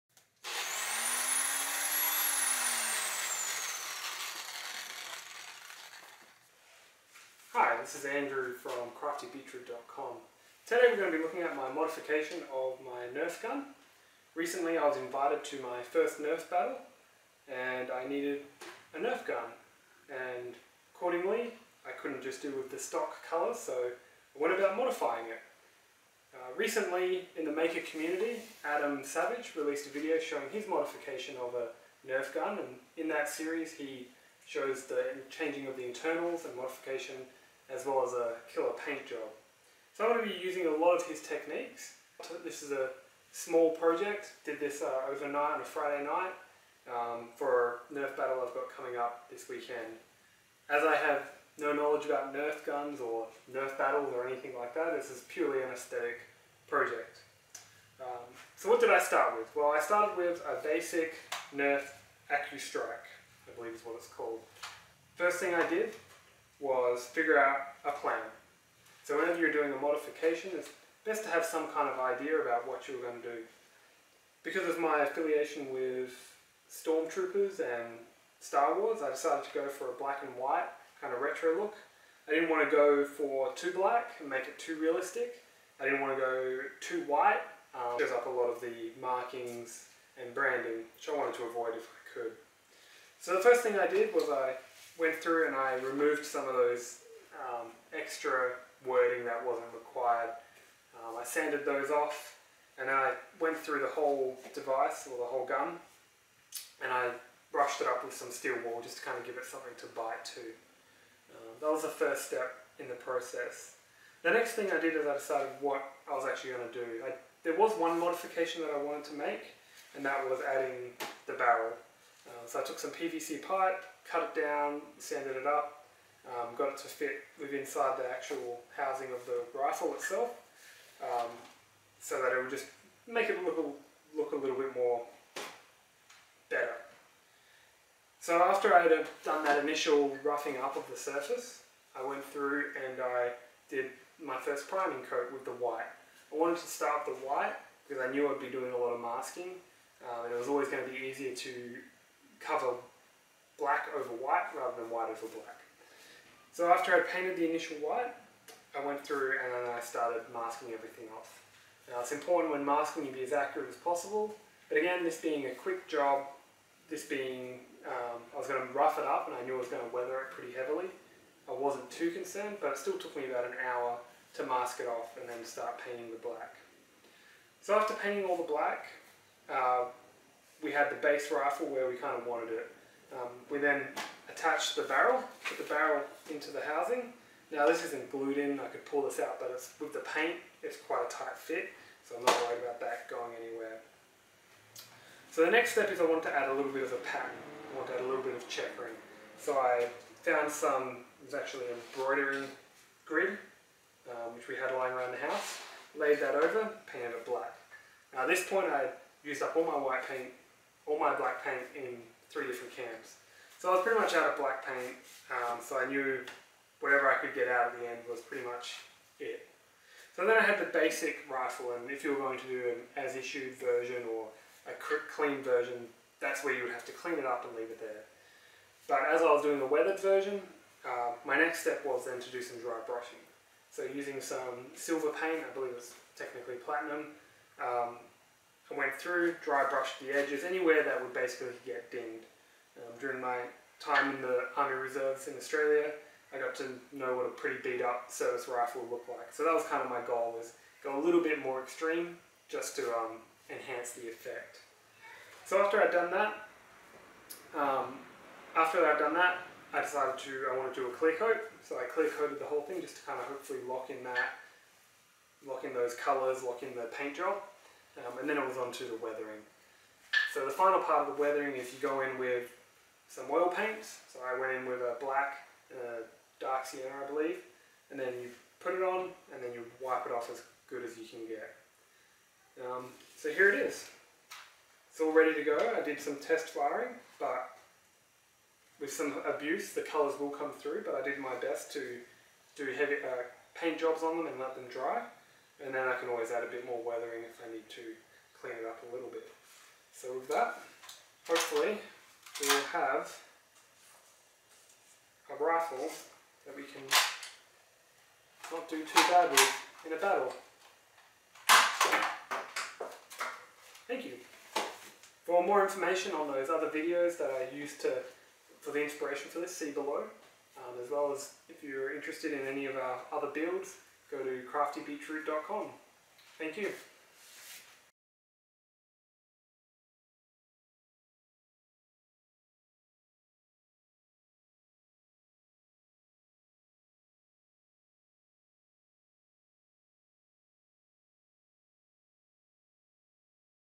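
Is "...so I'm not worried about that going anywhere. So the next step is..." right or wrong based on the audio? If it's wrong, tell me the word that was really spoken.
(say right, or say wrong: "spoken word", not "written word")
right.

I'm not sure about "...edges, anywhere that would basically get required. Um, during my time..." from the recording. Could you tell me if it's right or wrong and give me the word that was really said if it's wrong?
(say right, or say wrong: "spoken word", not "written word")
wrong: "dinged", not "required".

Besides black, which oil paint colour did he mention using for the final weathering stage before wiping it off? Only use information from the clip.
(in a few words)
Dark sienna.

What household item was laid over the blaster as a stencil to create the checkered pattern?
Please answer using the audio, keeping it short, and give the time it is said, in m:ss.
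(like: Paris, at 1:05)
An embroidery grid, at 3:21.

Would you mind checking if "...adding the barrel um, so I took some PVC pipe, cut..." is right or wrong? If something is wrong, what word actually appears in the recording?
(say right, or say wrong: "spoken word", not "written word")
right.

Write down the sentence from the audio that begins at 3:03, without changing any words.
Um, we then attached the barrel, put the barrel into the housing.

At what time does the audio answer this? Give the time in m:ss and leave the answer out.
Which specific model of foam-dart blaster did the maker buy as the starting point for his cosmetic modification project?
1:01.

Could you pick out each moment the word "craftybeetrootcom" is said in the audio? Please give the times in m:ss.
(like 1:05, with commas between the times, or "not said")
0:09, 5:24.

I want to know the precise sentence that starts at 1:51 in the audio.
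Um, that was the first step in the process.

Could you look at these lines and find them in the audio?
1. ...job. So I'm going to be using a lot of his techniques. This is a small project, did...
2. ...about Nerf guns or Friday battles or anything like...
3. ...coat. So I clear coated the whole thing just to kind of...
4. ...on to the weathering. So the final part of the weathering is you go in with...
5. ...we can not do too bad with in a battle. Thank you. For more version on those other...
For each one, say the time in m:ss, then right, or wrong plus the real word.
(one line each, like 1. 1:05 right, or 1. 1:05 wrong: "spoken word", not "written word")
1. 0:39 right
2. 0:52 wrong: "Nerf", not "Friday"
3. 4:21 right
4. 4:28 right
5. 5:06 wrong: "information", not "version".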